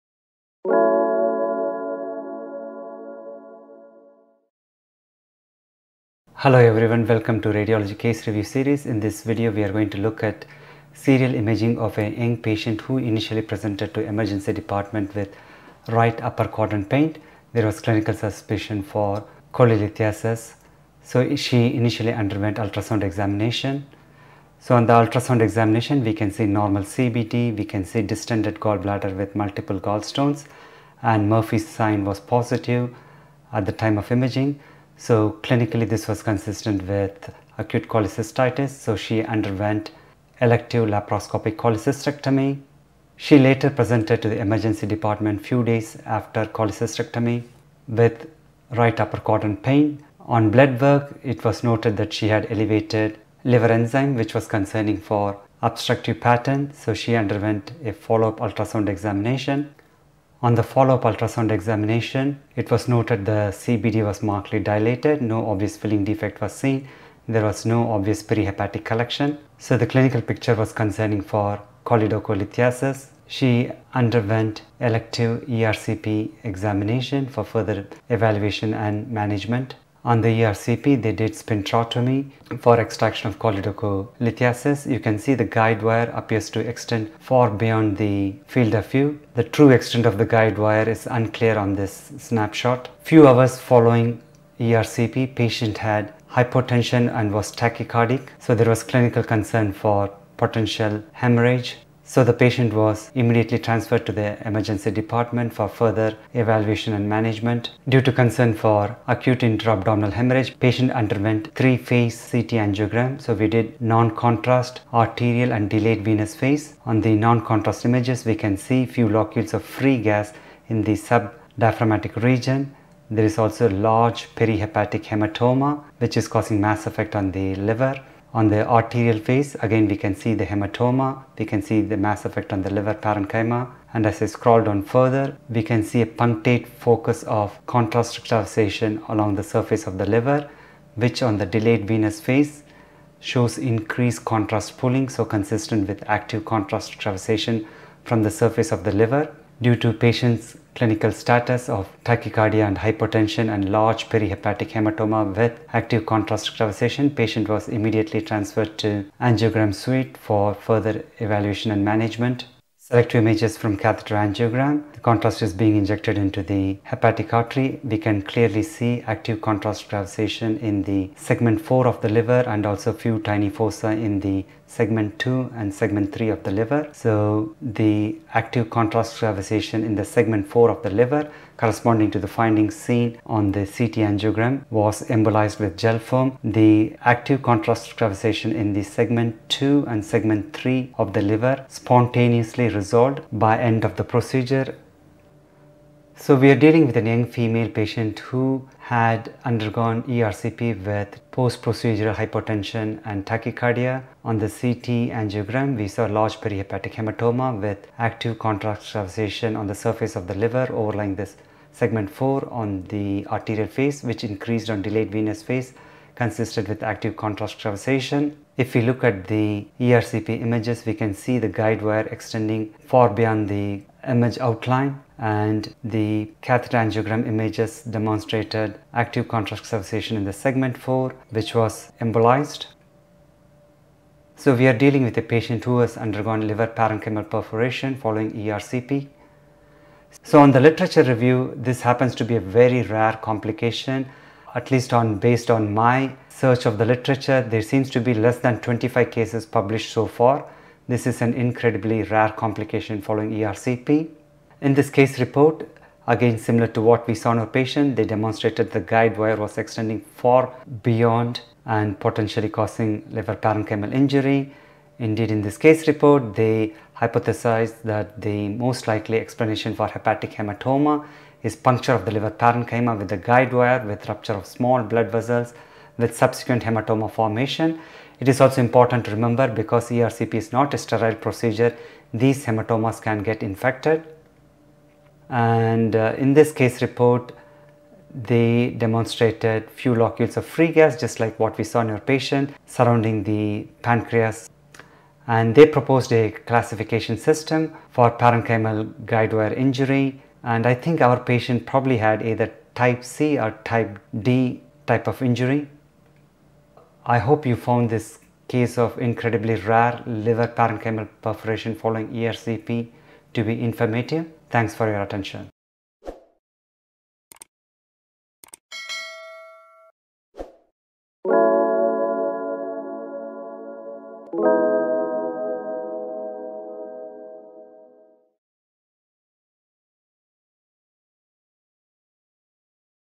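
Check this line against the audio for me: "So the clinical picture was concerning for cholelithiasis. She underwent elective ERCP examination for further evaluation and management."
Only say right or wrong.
right.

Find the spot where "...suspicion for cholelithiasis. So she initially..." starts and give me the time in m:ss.
0:18.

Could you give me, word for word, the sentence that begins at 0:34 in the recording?
So clinically this was consistent with acute cholecystitis.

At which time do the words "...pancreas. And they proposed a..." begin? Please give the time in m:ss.
4:53.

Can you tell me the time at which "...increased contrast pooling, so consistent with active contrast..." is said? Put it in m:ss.
2:23.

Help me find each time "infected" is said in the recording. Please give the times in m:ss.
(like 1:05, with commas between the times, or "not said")
4:43.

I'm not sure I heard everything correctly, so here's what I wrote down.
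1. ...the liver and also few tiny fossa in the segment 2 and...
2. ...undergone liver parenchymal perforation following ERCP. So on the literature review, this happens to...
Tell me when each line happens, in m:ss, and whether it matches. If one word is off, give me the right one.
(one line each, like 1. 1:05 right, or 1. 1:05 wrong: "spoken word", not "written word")
1. 2:52 right
2. 3:55 right.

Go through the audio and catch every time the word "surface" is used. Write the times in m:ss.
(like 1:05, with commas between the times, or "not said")
2:19, 2:28, 3:29.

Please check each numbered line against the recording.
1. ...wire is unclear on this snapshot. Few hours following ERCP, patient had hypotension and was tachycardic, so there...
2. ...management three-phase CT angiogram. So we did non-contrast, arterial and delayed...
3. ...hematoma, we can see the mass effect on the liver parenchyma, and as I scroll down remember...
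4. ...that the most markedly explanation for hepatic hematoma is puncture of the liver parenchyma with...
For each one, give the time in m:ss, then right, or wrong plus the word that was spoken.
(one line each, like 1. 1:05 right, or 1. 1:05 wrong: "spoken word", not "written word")
1. 1:30 right
2. 1:50 wrong: "underwent", not "management"
3. 2:10 wrong: "further", not "remember"
4. 4:27 wrong: "likely", not "markedly".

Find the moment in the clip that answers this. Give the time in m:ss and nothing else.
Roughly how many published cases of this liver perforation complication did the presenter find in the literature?
4:08.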